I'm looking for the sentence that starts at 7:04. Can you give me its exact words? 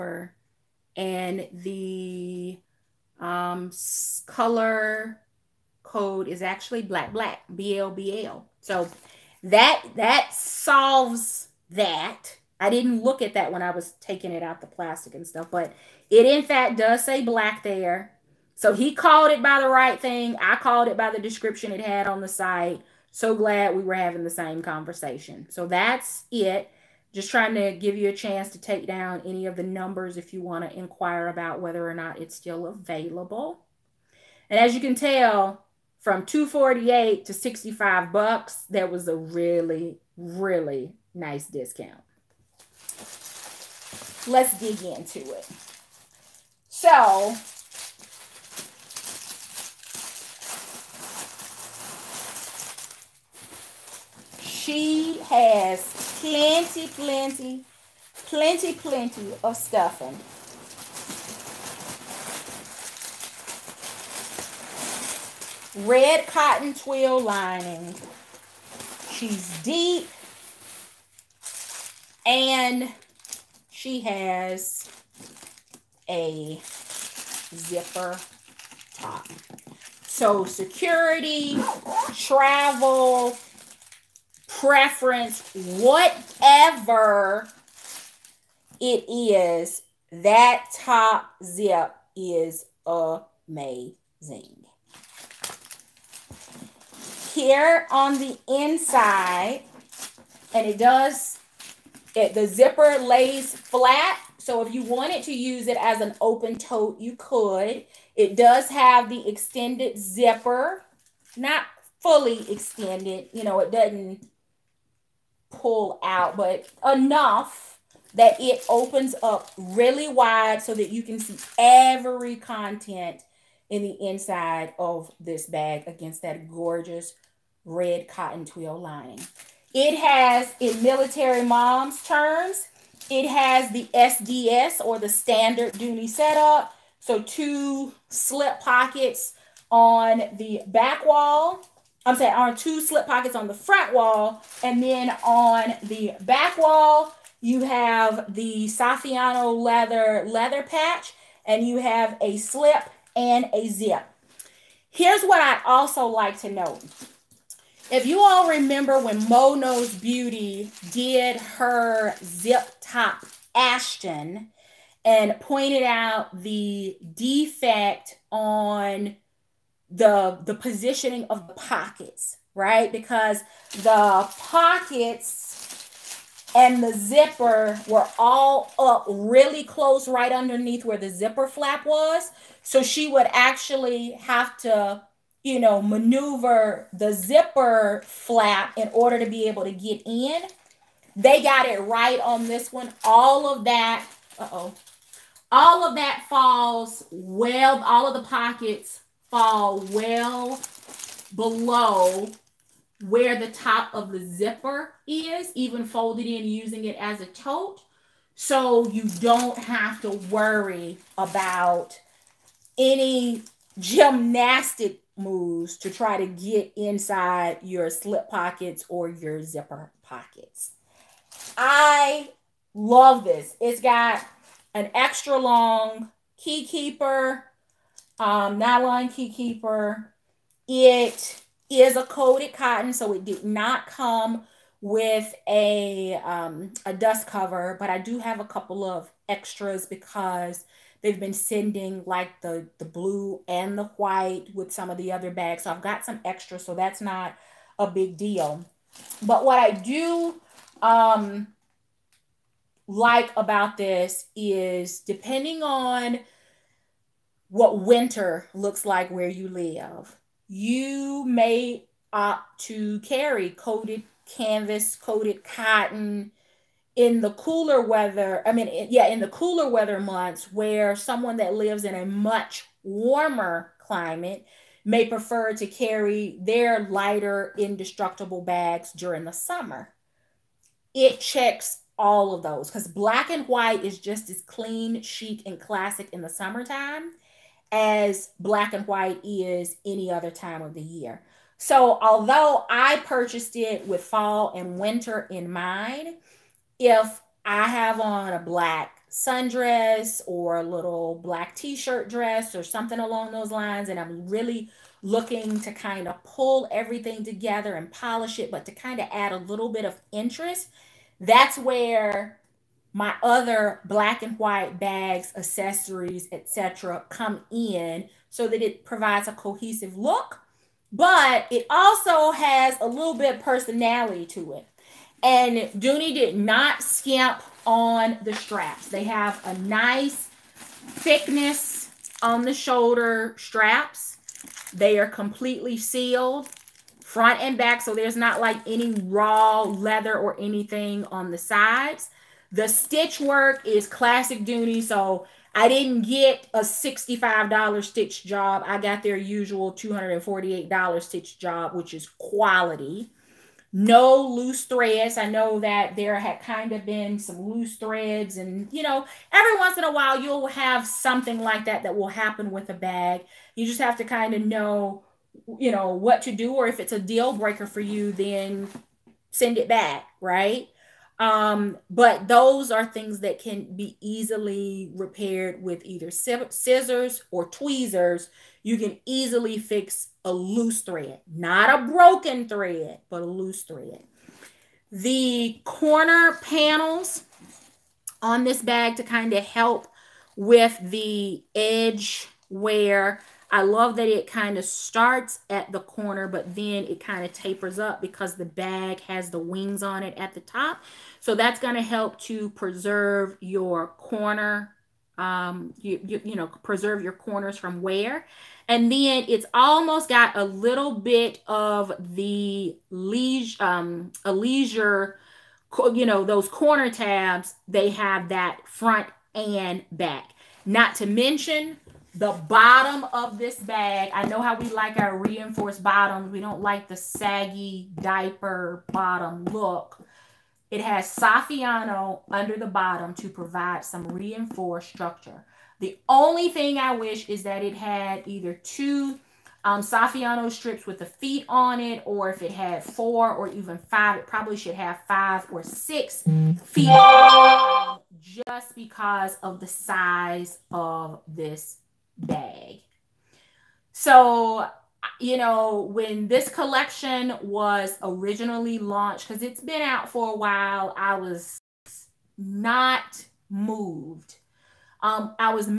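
I know how we like our reinforced bottoms.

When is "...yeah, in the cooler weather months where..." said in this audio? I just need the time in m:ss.
4:28.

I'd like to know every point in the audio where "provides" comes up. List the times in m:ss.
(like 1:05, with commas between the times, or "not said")
5:18, 7:13.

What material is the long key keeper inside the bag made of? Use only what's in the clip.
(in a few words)
Nylon.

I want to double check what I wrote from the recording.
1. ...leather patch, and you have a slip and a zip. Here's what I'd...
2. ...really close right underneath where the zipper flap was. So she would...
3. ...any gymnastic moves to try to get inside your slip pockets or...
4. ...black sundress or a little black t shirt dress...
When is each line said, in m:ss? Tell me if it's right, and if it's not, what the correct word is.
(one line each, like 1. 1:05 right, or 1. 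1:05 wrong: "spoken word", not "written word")
1. 2:30 right
2. 2:59 right
3. 3:32 right
4. 4:58 right.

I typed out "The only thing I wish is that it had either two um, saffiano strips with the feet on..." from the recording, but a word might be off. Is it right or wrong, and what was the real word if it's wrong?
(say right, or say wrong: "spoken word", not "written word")
right.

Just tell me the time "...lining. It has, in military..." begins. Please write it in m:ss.
2:08.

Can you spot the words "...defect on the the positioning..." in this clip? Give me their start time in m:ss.
2:47.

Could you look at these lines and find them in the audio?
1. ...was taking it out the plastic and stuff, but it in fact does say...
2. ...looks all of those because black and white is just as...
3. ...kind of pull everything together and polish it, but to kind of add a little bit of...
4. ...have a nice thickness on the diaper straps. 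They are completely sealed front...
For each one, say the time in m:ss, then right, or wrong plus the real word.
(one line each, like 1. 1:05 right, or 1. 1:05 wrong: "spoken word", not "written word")
1. 0:13 right
2. 4:41 wrong: "checks", not "looks"
3. 5:05 right
4. 5:29 wrong: "shoulder", not "diaper".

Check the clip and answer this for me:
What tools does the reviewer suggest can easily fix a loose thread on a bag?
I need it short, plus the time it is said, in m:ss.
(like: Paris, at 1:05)
Scissors or tweezers, at 6:16.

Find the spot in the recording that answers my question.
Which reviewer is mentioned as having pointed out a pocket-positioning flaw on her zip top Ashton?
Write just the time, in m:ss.
2:39.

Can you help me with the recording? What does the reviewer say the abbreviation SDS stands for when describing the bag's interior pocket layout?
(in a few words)
Standard Dooney setup.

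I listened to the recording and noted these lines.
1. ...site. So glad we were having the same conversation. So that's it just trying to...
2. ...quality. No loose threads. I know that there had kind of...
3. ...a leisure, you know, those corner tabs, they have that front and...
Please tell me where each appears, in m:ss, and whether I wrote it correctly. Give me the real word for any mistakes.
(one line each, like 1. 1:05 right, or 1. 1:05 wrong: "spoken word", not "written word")
1. 0:22 right
2. 5:52 right
3. 6:54 right.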